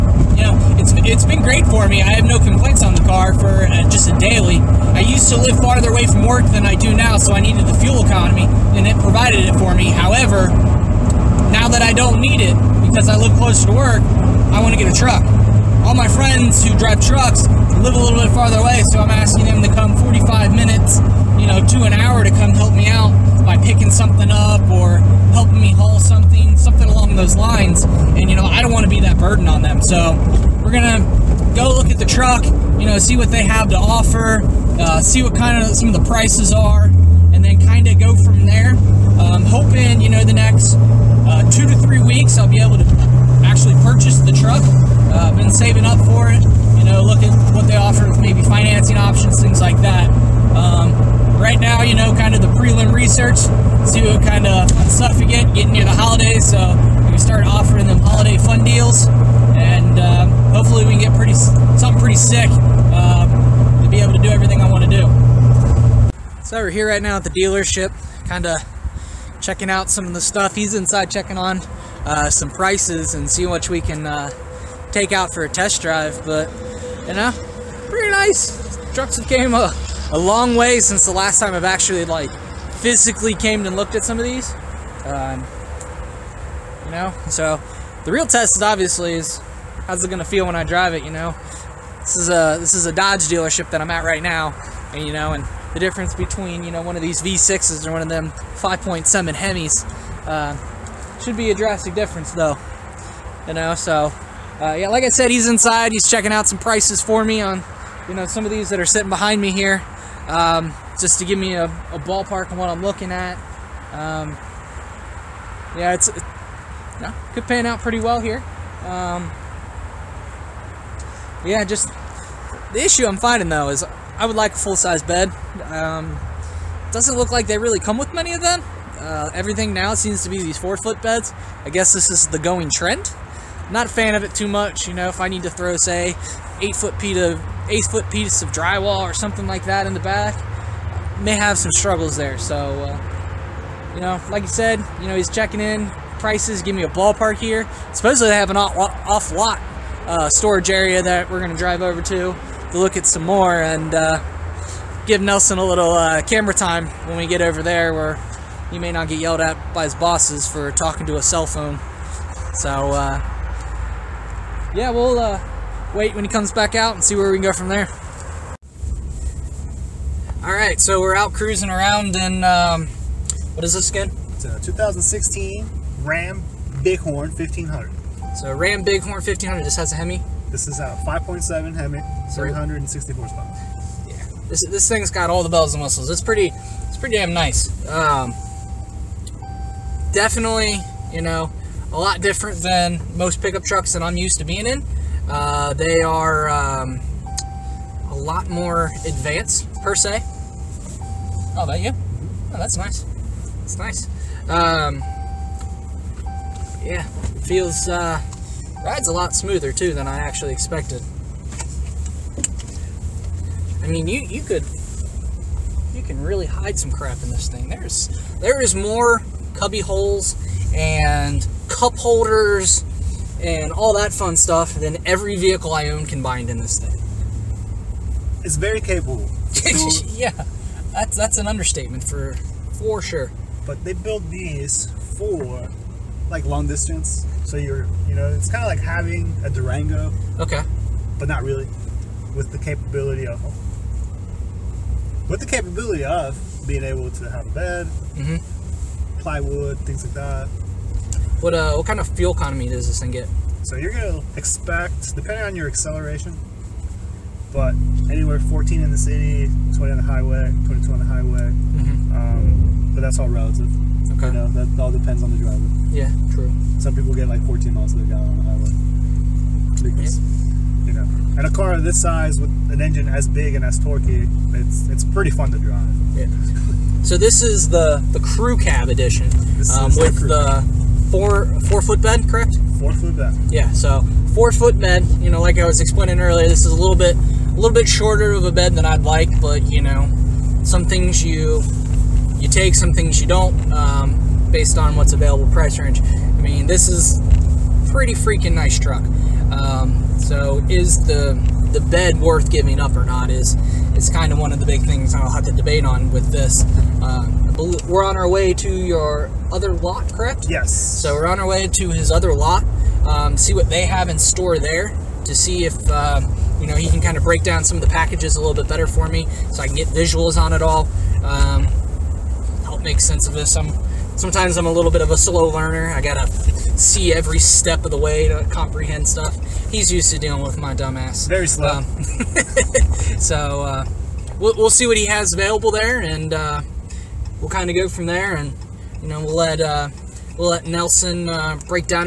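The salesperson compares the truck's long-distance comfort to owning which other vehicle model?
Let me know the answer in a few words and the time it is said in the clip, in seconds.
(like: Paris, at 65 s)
Durango, at 239 s.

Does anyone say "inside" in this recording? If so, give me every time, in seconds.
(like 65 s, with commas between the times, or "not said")
70 s, 105 s.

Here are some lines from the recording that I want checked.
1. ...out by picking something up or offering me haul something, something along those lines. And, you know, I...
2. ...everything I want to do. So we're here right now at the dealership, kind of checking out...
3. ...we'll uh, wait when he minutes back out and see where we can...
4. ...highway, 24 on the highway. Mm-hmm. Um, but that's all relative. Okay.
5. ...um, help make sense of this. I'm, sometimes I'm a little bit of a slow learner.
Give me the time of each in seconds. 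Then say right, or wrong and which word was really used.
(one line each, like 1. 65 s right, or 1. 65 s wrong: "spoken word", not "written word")
1. 22 s wrong: "helping", not "offering"
2. 64 s right
3. 164 s wrong: "comes", not "minutes"
4. 260 s wrong: "22", not "24"
5. 321 s right.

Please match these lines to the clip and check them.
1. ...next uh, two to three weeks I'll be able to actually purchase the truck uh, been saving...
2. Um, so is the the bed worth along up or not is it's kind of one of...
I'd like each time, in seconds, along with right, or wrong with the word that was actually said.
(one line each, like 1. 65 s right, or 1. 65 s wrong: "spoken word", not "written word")
1. 40 s right
2. 299 s wrong: "giving", not "along".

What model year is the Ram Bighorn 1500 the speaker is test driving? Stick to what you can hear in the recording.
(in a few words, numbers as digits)
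2016.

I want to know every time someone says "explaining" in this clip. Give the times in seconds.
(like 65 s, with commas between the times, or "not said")
285 s.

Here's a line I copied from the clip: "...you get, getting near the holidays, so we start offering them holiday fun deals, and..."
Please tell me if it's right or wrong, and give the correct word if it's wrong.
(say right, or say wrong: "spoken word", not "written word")
right.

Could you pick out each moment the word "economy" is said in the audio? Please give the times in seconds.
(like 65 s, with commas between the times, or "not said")
8 s, 252 s.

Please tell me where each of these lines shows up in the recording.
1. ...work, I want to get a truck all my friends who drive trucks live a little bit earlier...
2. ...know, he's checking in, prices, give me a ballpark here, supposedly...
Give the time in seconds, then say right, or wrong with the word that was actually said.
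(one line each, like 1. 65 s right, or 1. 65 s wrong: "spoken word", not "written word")
1. 13 s wrong: "farther", not "earlier"
2. 145 s right.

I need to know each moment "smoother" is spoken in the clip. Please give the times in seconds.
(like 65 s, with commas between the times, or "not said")
209 s.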